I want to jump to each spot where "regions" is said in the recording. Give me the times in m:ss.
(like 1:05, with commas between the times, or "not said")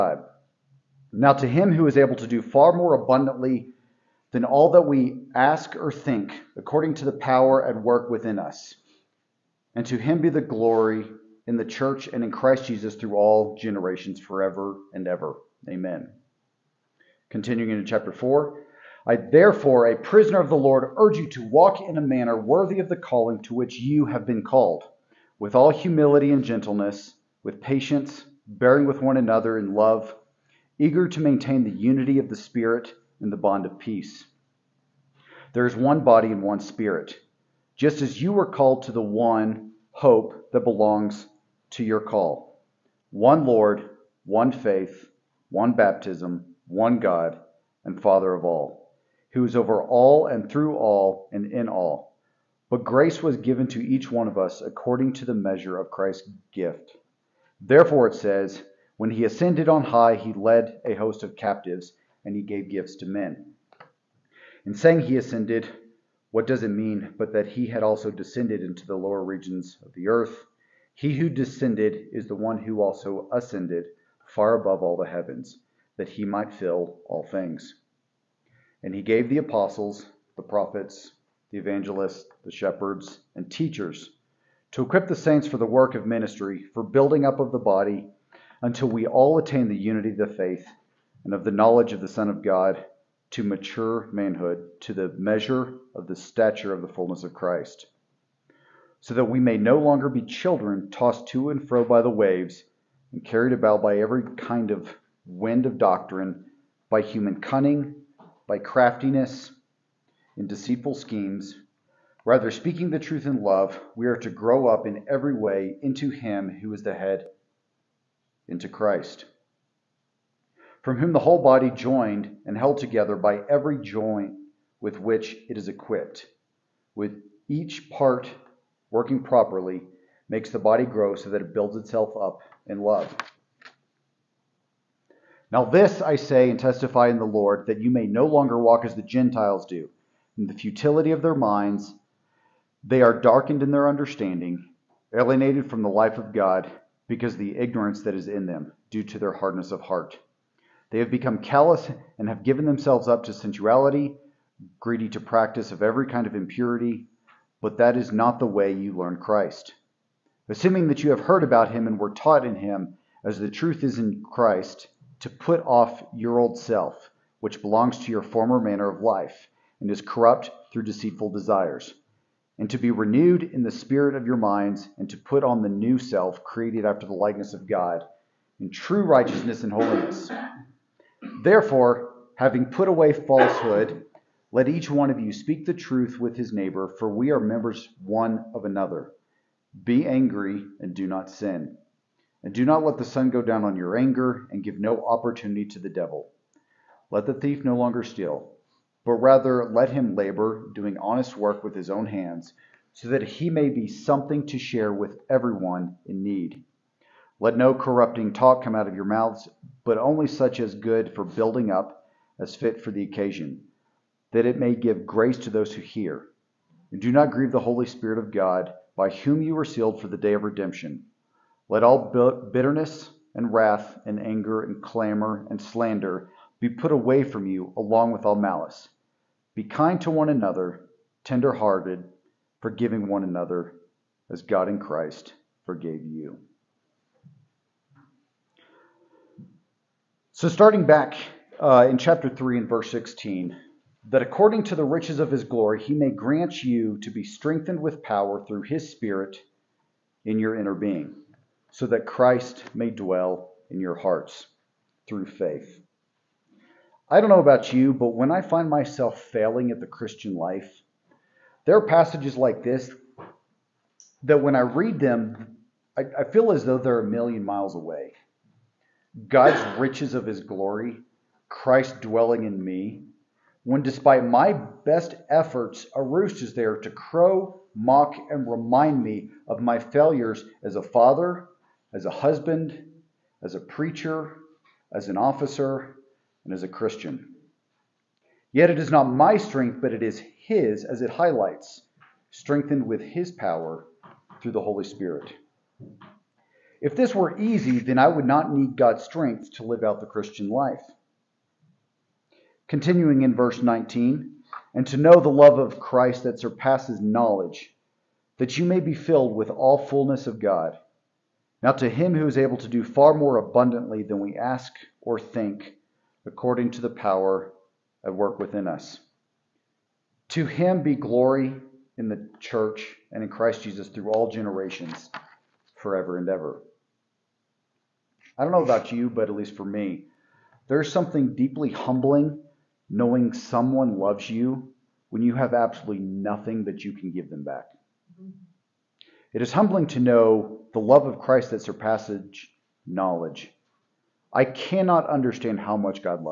1:09.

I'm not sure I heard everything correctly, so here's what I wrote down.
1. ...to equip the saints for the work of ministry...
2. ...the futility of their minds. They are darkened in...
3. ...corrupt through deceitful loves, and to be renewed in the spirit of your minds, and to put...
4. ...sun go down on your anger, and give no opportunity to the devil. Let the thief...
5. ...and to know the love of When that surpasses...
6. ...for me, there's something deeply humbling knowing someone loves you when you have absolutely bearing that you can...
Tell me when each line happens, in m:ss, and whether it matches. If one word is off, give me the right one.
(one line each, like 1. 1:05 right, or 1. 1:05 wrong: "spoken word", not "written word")
1. 1:24 right
2. 2:20 right
3. 2:50 wrong: "desires", not "loves"
4. 3:13 right
5. 5:04 wrong: "Christ", not "When"
6. 5:29 wrong: "nothing", not "bearing".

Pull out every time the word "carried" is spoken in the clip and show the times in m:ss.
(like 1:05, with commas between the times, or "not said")
1:43.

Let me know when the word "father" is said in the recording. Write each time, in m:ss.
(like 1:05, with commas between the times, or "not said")
0:47, 4:40.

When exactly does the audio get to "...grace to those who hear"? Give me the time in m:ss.
3:35.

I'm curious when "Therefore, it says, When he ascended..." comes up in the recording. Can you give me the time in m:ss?
0:57.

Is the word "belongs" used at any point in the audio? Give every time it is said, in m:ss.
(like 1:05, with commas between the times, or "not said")
0:40, 2:47.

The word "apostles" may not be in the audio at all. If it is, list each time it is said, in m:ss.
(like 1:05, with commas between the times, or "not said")
1:19.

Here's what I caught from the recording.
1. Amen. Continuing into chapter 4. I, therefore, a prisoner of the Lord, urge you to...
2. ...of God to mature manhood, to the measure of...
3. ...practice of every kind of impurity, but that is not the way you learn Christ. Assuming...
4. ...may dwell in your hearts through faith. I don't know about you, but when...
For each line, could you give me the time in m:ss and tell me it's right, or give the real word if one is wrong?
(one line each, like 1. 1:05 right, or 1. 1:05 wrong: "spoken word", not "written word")
1. 0:15 right
2. 1:32 right
3. 2:35 right
4. 4:12 right.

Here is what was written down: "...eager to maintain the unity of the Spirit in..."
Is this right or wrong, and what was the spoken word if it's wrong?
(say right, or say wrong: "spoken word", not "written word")
right.